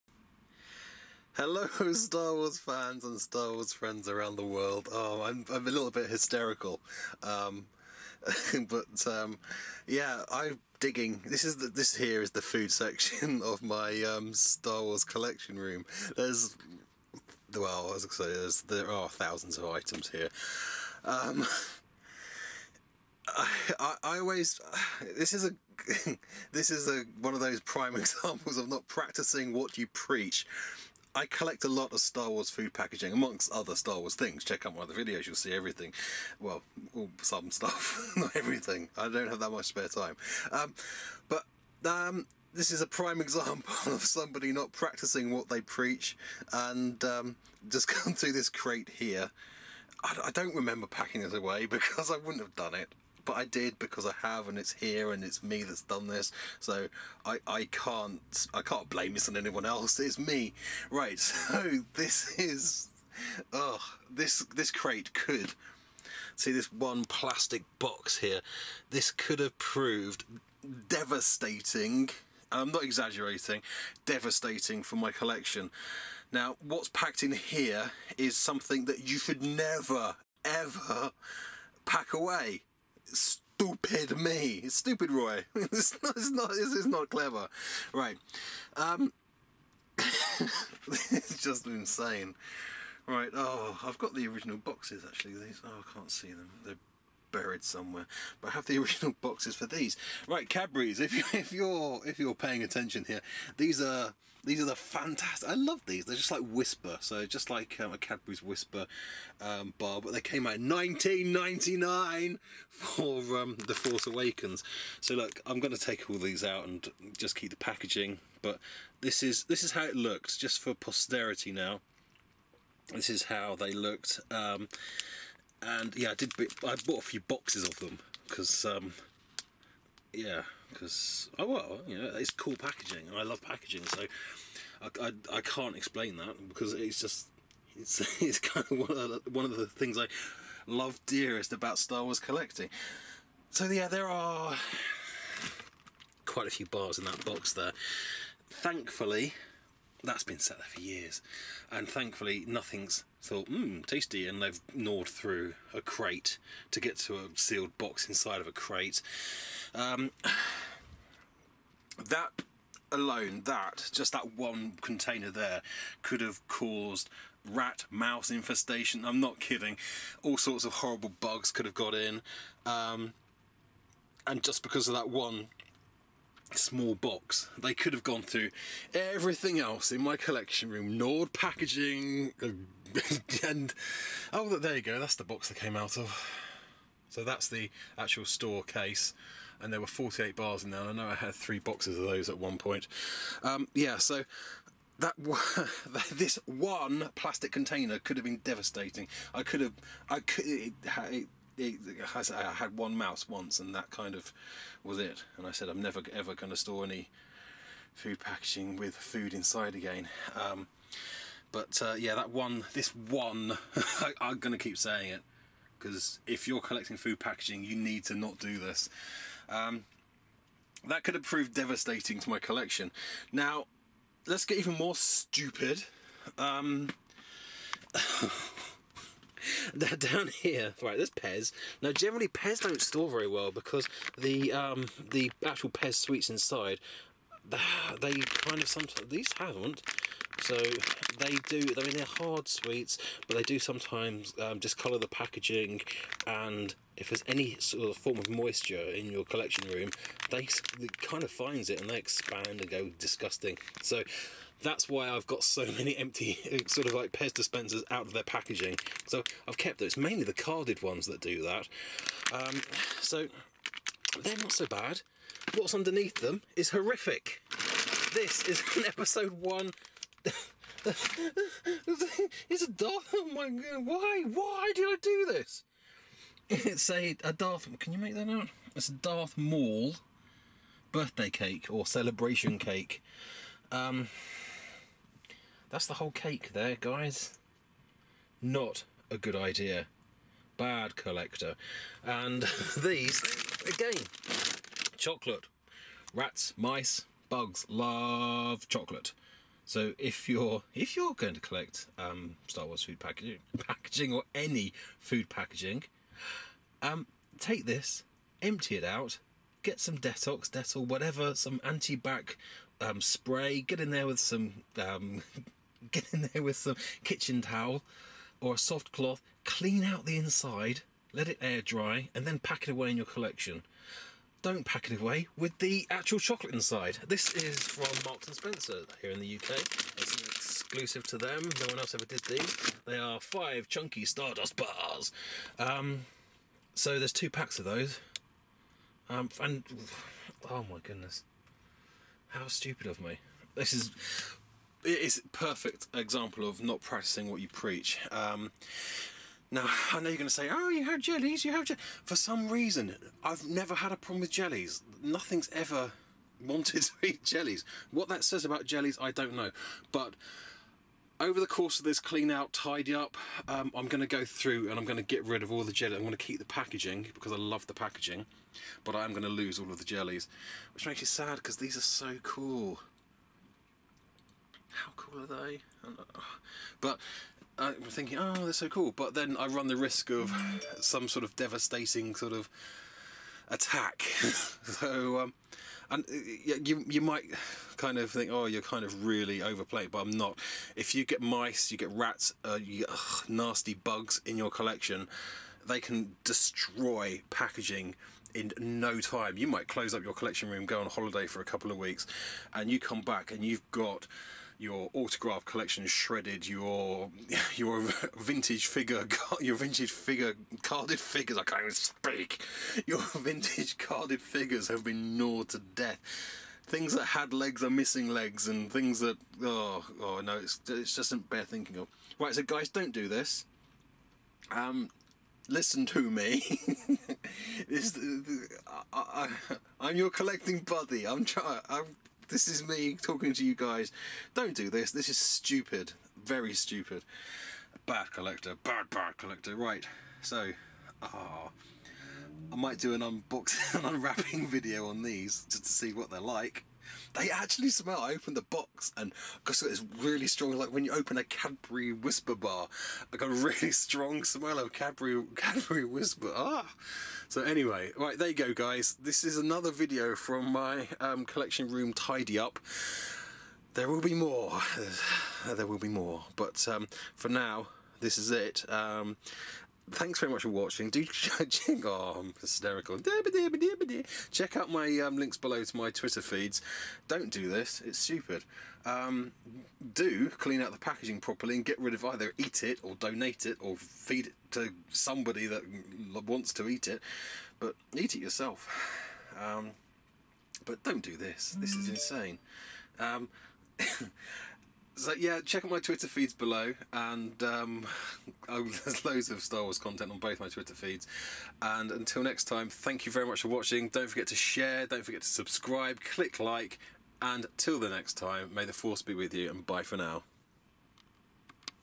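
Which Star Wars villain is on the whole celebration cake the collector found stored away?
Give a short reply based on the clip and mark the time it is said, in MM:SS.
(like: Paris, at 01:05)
Darth Maul, at 04:38.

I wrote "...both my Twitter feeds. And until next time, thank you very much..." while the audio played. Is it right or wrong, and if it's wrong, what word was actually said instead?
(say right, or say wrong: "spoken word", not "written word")
right.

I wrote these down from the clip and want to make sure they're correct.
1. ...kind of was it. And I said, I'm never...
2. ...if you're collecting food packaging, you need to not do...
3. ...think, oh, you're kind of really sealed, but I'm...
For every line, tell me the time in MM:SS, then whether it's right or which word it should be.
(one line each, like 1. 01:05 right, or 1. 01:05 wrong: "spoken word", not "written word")
1. 03:23 right
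2. 03:36 right
3. 06:28 wrong: "overplayed", not "sealed".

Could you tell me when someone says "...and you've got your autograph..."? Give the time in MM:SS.
06:43.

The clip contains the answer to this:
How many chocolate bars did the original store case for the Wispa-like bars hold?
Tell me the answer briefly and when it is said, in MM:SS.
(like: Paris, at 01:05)
48, at 03:09.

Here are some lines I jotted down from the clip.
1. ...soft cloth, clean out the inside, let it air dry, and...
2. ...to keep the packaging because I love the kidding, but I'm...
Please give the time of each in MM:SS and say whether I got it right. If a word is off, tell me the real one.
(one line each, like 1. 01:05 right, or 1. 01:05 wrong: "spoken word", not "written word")
1. 05:18 right
2. 06:06 wrong: "packaging", not "kidding".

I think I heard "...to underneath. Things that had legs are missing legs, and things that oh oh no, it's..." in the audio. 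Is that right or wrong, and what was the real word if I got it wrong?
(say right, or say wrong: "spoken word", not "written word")
wrong: "death", not "underneath".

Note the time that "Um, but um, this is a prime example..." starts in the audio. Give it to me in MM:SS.
00:40.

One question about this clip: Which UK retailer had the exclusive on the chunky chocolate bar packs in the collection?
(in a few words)
Marks and Spencer.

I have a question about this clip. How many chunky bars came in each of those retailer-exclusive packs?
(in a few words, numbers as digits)
5.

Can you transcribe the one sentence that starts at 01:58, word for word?
But this is this is how it looked just for posterity now.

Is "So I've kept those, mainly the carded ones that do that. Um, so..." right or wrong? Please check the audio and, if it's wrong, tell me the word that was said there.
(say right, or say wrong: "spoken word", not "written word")
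right.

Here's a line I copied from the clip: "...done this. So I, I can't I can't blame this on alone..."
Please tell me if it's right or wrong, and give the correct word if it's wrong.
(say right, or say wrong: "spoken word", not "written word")
wrong: "anyone", not "alone".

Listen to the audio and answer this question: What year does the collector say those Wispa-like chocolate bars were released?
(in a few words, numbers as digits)
1999.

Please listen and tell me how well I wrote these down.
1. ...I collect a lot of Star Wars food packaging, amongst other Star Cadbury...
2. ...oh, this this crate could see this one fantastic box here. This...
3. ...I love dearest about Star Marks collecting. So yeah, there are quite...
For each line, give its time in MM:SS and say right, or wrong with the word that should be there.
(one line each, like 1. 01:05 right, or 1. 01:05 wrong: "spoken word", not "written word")
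1. 00:31 wrong: "Wars", not "Cadbury"
2. 01:03 wrong: "plastic", not "fantastic"
3. 02:19 wrong: "Wars", not "Marks".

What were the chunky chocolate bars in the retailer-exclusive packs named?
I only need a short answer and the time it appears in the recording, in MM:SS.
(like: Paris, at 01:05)
Stardust bars, at 05:34.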